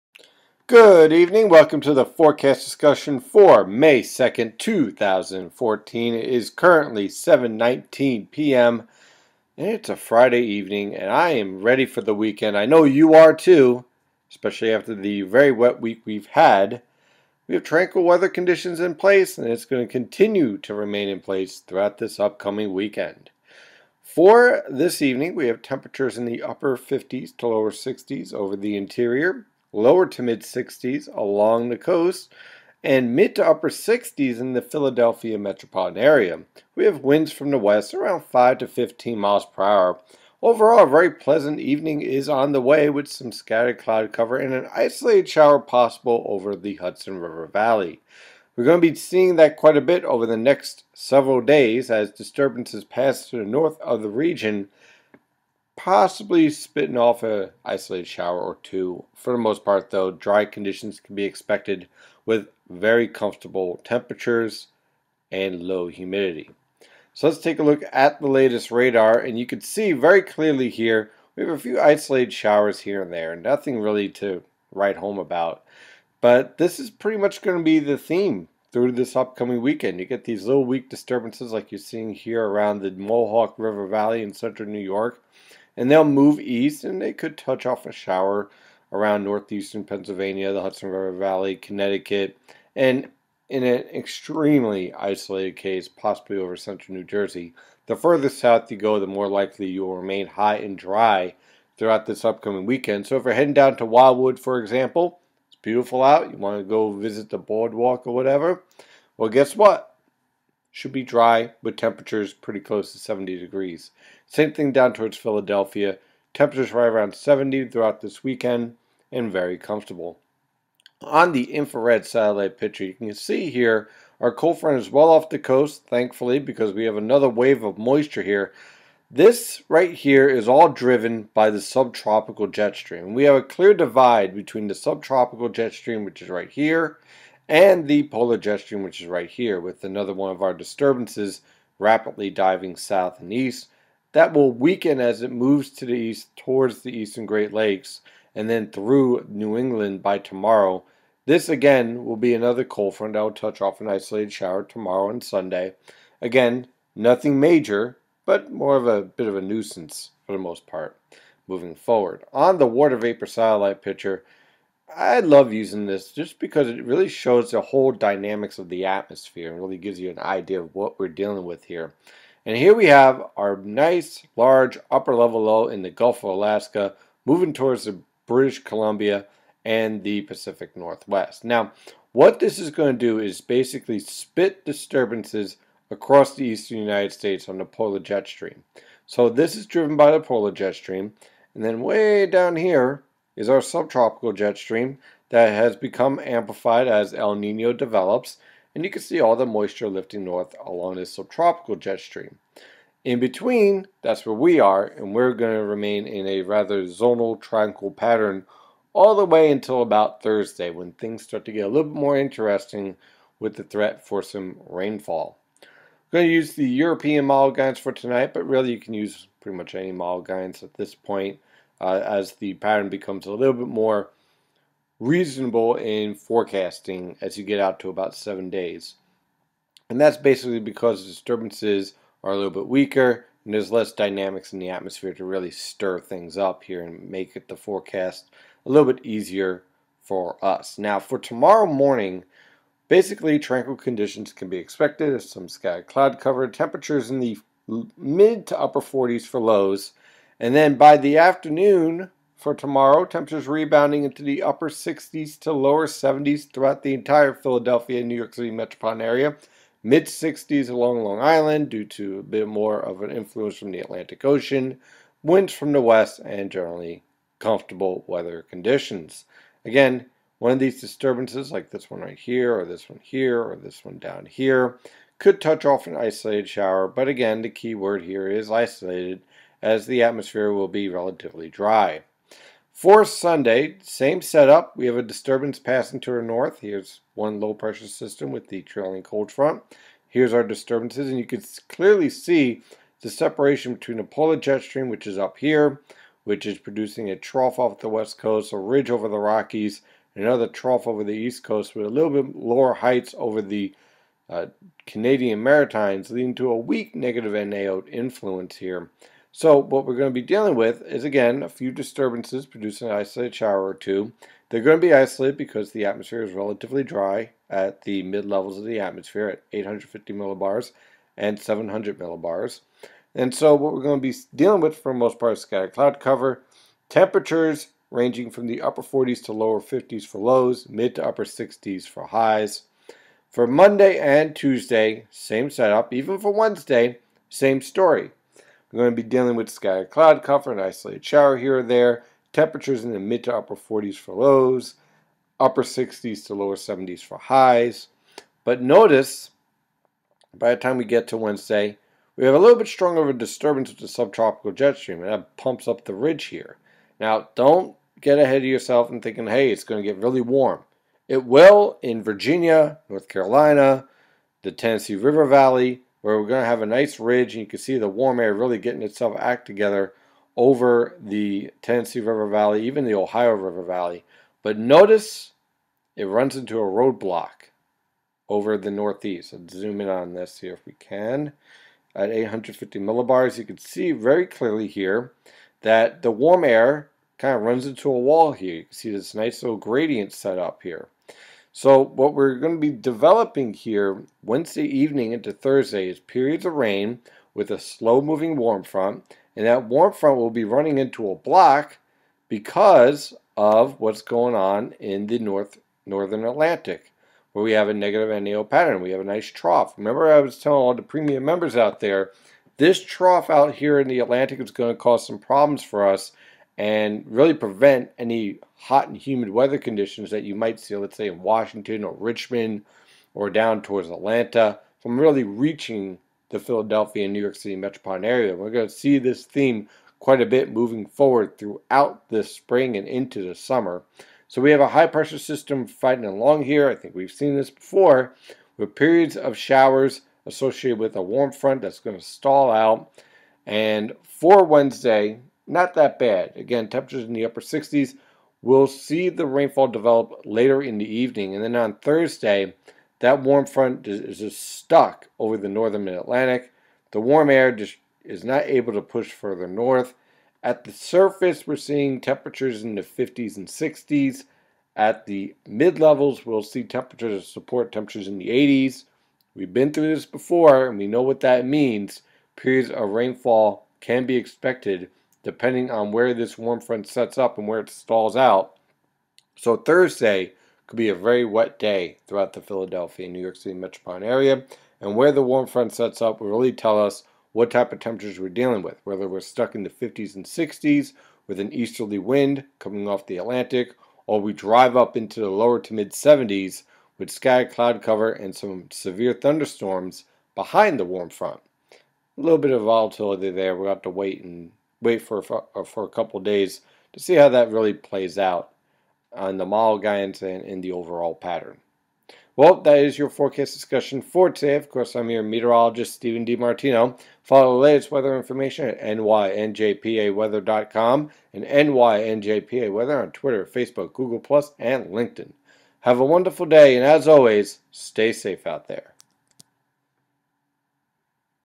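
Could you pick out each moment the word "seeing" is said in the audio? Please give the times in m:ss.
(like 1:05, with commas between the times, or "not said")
0:48, 1:21, 7:41.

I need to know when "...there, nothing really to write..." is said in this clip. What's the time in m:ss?
1:13.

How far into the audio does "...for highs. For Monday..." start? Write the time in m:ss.
5:31.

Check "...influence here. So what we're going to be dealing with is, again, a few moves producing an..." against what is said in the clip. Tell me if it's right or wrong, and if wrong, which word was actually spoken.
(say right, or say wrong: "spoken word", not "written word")
wrong: "disturbances", not "moves".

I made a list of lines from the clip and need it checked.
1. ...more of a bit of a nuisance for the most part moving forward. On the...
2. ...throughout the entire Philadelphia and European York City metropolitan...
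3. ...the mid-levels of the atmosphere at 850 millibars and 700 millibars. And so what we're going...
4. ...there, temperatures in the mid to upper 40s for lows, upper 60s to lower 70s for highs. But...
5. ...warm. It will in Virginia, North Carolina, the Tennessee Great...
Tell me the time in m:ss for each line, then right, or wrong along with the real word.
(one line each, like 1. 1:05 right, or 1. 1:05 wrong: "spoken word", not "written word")
1. 2:38 right
2. 4:16 wrong: "New", not "European"
3. 5:17 right
4. 5:41 right
5. 6:00 wrong: "River", not "Great".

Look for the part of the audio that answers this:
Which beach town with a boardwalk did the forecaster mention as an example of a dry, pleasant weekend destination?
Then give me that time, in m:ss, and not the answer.
1:43.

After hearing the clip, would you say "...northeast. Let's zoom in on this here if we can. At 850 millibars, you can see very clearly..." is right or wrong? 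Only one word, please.
right.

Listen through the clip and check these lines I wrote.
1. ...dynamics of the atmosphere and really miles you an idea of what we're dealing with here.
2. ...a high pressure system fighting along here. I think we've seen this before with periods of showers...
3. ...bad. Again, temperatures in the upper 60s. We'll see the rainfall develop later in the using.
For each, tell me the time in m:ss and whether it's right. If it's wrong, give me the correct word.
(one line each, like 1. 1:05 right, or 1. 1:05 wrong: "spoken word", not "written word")
1. 2:47 wrong: "gives", not "miles"
2. 7:14 right
3. 7:25 wrong: "evening", not "using".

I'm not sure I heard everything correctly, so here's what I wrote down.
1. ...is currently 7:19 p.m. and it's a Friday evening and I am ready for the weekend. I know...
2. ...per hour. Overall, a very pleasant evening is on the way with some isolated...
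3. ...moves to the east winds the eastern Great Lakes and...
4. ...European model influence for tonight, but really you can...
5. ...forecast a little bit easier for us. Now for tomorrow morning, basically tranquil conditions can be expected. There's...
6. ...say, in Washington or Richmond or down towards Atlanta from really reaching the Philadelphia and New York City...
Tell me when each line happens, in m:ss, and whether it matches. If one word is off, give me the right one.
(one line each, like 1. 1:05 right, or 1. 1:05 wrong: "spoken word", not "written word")
1. 0:06 right
2. 0:39 wrong: "scattered", not "isolated"
3. 2:25 wrong: "towards", not "winds"
4. 3:36 wrong: "guidance", not "influence"
5. 3:57 right
6. 7:00 right.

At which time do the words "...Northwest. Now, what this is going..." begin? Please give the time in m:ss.
3:00.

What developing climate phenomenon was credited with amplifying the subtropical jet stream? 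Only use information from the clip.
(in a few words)
El Nino.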